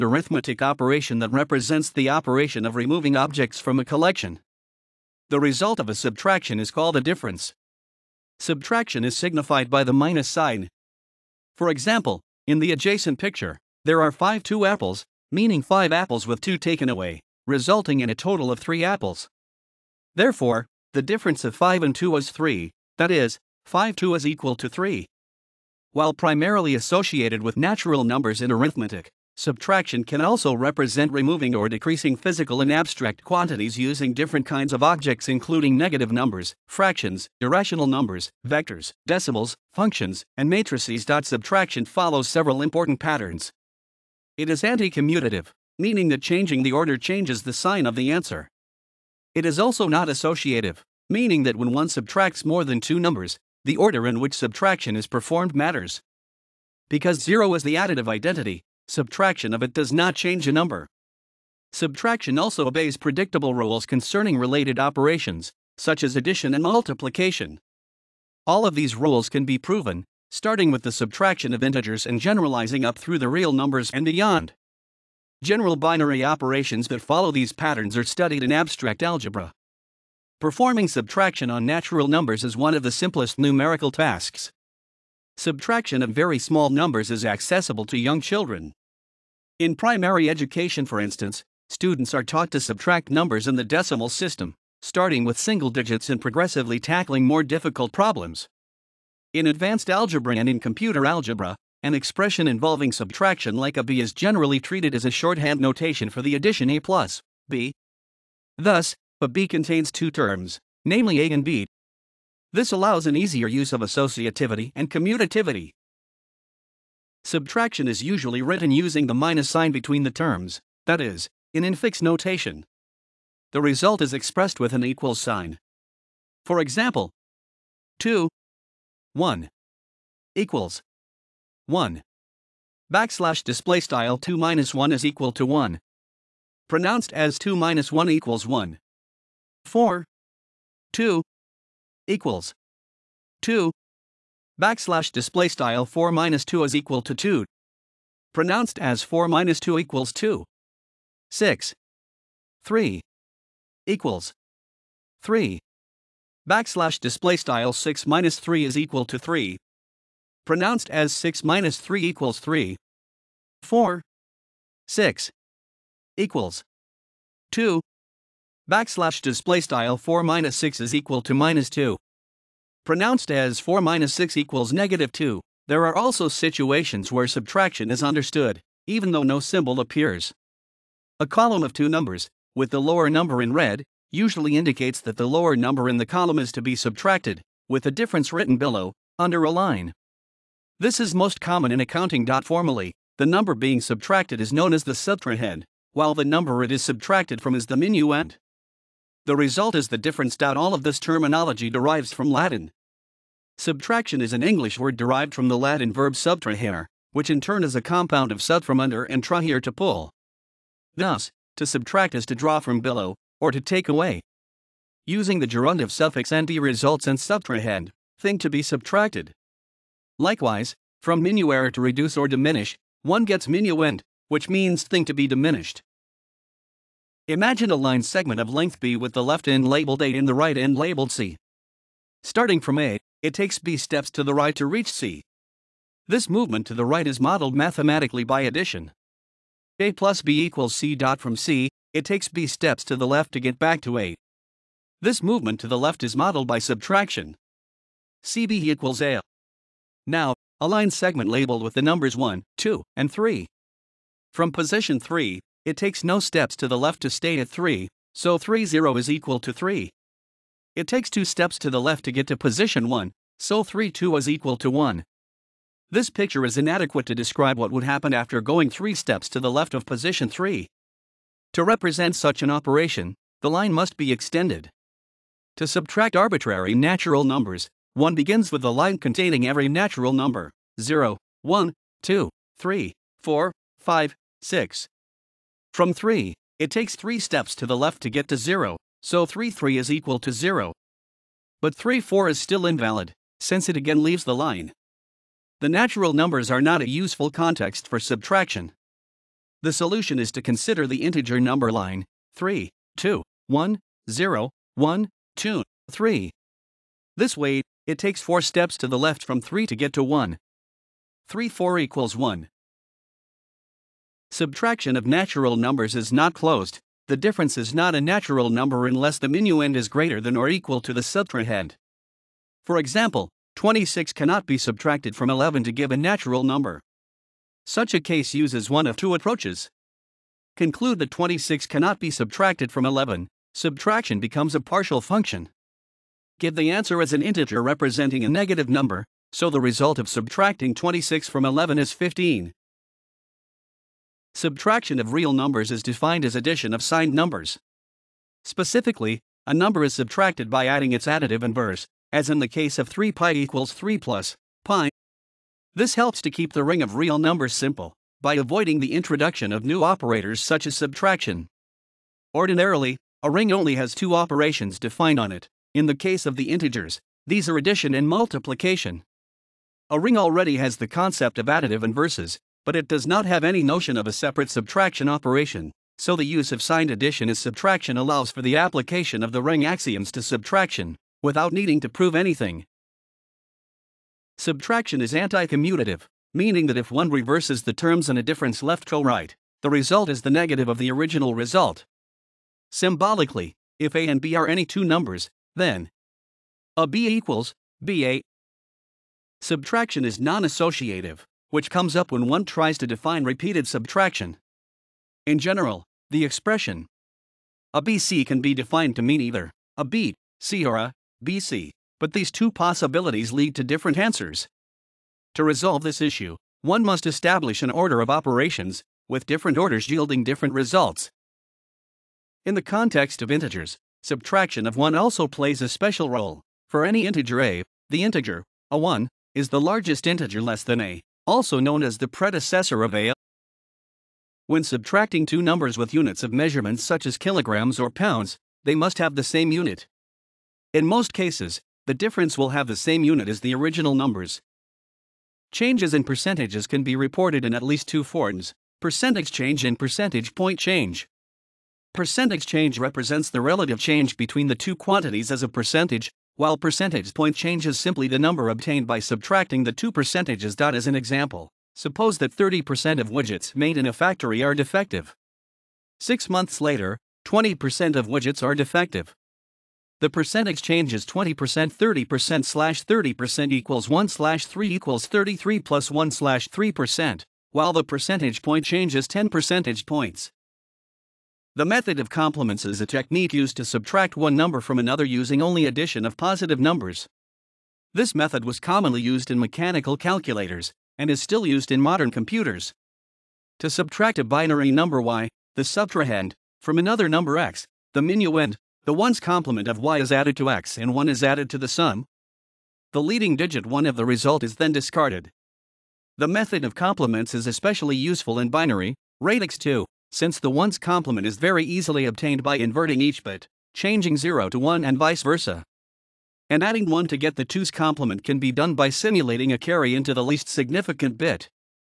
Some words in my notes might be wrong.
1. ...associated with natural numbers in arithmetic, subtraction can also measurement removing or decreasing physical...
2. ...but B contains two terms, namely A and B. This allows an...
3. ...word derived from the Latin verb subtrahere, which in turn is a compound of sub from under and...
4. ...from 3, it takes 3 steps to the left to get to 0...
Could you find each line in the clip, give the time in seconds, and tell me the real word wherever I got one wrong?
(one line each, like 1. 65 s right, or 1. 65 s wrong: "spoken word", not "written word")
1. 26 s wrong: "represent", not "measurement"
2. 109 s right
3. 204 s right
4. 285 s right.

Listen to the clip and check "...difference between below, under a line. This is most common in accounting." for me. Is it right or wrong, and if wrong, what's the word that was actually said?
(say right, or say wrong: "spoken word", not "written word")
wrong: "written", not "between".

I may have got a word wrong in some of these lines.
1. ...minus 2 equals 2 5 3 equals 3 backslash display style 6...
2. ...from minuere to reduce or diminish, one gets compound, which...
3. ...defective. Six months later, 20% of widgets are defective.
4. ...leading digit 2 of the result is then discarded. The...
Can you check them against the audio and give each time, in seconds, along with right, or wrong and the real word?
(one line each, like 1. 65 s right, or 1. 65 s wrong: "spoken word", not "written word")
1. 149 s wrong: "6", not "5"
2. 220 s wrong: "minuend", not "compound"
3. 464 s right
4. 503 s wrong: "1", not "2".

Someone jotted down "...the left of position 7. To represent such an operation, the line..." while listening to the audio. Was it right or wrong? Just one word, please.
wrong.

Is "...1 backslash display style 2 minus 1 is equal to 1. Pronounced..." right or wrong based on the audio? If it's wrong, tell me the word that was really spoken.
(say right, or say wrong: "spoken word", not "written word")
right.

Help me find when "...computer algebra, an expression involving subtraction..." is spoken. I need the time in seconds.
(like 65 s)
100 s.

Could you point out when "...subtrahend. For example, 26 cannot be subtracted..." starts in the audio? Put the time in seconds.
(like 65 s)
321 s.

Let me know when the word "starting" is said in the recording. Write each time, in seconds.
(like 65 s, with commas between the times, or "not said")
70 s, 94 s, 232 s.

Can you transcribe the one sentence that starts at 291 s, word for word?
But 3 4 is still invalid, since it again leaves the line.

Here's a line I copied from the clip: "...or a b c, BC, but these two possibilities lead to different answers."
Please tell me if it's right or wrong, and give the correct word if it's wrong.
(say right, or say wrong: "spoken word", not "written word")
right.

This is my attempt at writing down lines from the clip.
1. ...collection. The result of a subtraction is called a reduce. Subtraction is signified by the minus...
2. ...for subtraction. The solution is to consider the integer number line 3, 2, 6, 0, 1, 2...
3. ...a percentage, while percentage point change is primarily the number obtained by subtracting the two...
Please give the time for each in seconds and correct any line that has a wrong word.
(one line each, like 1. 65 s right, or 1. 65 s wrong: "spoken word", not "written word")
1. 3 s wrong: "difference", not "reduce"
2. 297 s wrong: "1", not "6"
3. 455 s wrong: "simply", not "primarily".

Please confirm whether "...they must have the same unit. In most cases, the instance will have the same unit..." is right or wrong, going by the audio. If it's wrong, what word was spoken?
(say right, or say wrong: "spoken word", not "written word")
wrong: "difference", not "instance".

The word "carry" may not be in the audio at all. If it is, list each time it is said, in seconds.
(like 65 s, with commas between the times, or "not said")
519 s.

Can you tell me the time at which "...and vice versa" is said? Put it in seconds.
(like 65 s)
514 s.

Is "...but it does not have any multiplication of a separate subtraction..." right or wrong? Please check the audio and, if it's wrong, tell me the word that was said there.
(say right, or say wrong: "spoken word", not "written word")
wrong: "notion", not "multiplication".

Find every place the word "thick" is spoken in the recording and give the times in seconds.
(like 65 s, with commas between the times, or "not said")
not said.